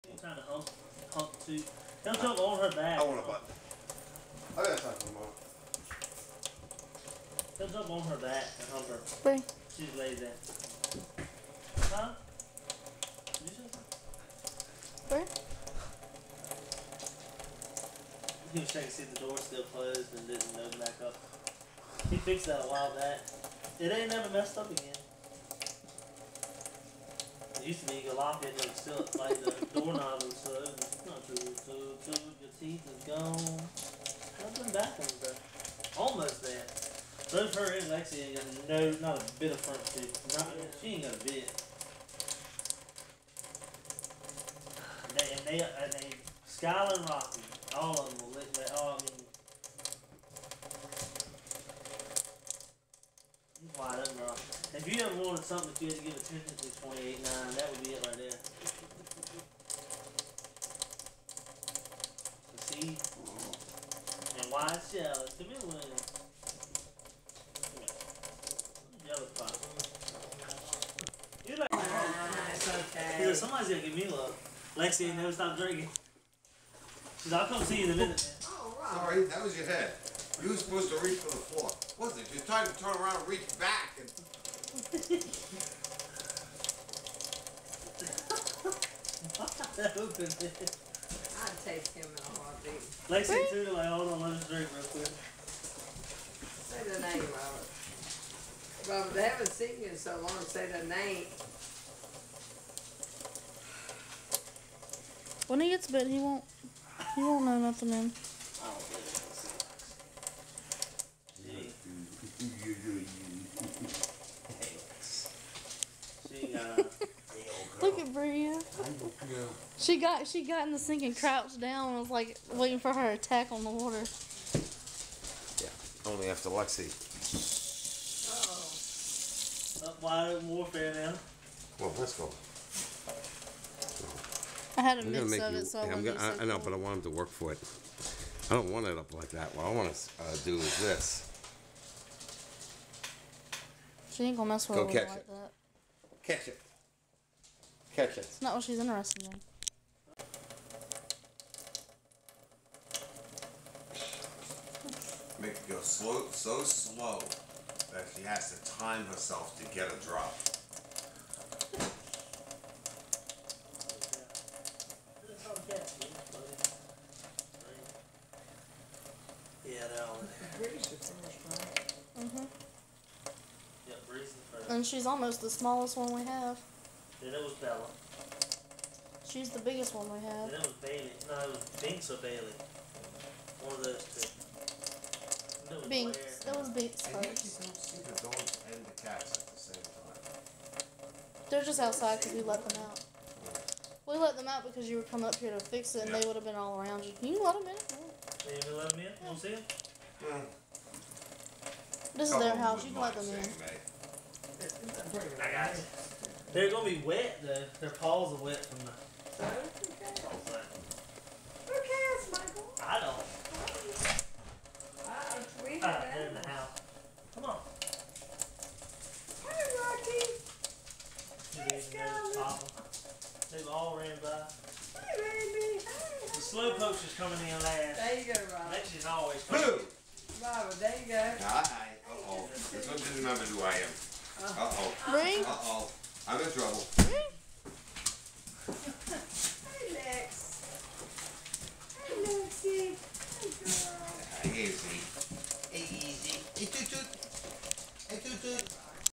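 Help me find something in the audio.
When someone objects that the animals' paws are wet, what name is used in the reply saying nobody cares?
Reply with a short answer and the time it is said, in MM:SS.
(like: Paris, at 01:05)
Michael, at 03:32.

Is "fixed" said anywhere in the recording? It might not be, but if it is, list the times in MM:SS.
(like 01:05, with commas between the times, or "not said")
00:22.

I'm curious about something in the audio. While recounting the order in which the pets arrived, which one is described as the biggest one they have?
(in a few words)
Bella.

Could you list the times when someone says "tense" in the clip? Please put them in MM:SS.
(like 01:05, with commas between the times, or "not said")
not said.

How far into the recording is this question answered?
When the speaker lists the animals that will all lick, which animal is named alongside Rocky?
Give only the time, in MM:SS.
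00:46.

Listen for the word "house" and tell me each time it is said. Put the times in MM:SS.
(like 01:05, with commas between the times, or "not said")
03:22, 03:36.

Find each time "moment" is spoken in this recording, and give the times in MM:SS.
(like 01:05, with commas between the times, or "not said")
00:05.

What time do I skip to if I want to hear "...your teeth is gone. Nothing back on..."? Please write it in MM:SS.
00:32.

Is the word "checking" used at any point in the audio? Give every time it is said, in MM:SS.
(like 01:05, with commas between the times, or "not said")
00:18.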